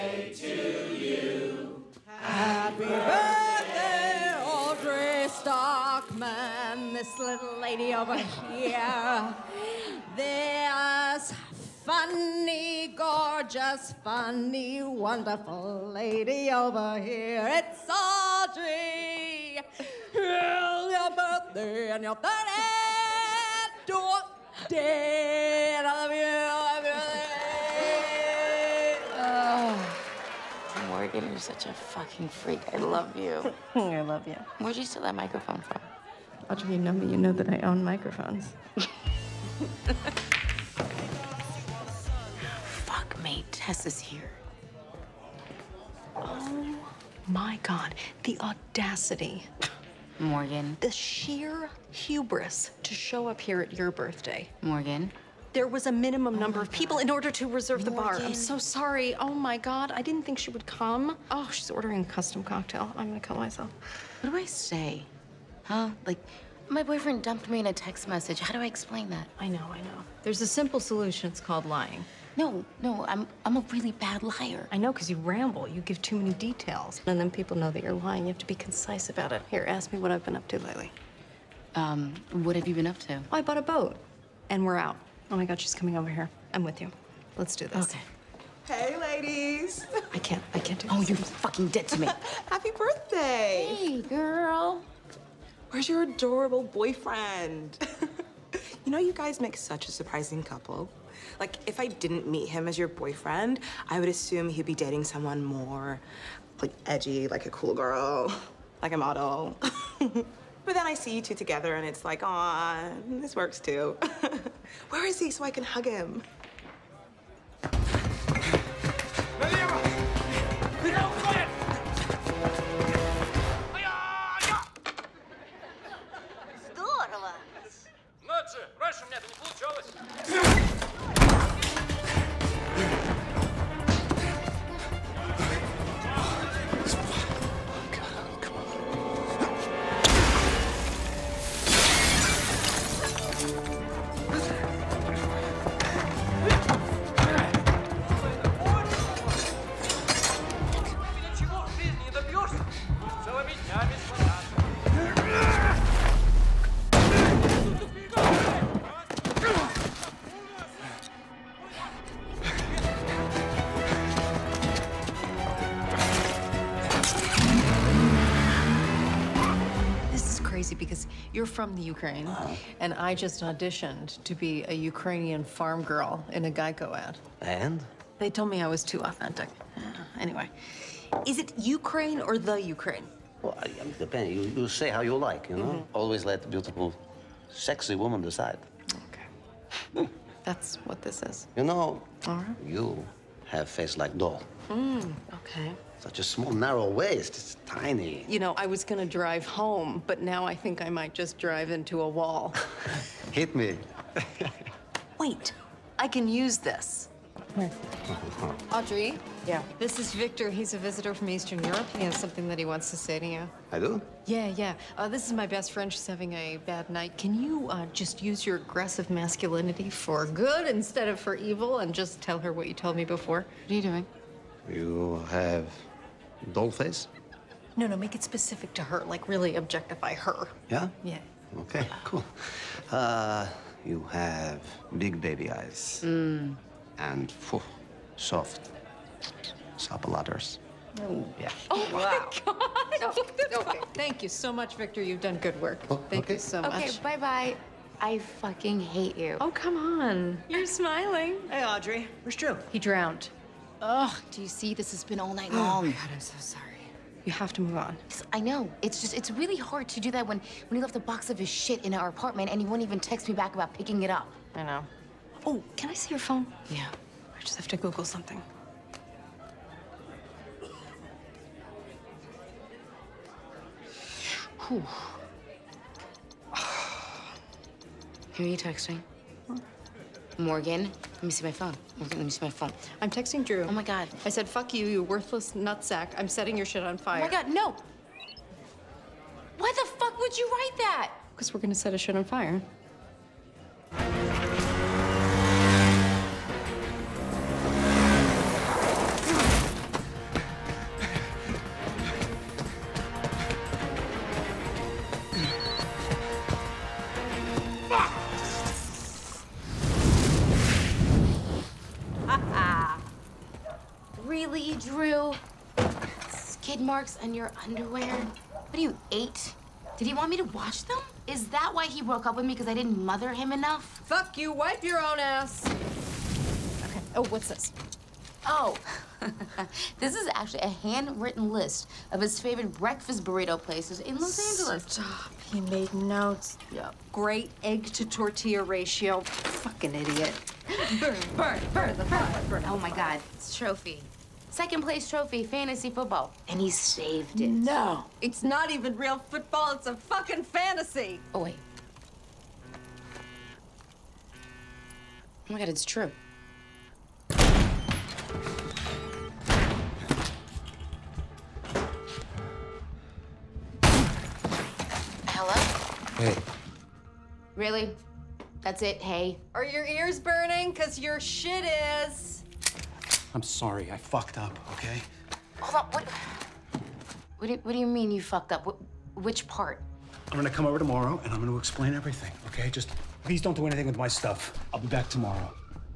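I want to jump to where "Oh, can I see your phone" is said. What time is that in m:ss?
4:25.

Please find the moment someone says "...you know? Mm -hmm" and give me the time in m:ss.
3:05.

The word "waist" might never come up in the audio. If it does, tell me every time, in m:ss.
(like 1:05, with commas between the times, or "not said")
3:16.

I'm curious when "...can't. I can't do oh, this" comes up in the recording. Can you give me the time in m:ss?
1:30.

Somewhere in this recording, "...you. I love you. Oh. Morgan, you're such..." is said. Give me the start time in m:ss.
0:26.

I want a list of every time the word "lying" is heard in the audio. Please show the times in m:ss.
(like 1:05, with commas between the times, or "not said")
1:11, 1:17.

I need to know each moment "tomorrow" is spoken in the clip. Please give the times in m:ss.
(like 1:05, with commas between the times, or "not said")
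6:20, 6:25.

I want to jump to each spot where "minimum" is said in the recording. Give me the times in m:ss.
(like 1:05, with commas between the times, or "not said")
0:55.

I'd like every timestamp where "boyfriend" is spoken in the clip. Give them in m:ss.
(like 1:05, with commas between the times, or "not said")
1:06, 1:36, 1:42.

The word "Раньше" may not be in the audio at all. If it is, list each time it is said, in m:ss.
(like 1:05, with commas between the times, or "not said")
2:08.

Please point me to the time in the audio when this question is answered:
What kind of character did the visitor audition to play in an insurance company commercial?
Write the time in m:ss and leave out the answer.
2:54.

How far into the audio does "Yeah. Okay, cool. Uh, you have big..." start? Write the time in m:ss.
3:51.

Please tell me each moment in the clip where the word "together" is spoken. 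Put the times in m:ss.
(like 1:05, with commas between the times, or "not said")
1:51.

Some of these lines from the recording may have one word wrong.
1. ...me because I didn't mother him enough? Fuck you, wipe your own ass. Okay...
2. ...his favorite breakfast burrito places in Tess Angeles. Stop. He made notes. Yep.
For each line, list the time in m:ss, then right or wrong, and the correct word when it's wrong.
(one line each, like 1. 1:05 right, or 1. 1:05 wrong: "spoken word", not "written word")
1. 5:22 right
2. 5:32 wrong: "Los", not "Tess".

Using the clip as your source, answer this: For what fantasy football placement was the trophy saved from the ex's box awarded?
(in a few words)
Second place.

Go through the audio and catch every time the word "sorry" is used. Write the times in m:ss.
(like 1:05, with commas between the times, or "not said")
0:58, 4:16, 6:13.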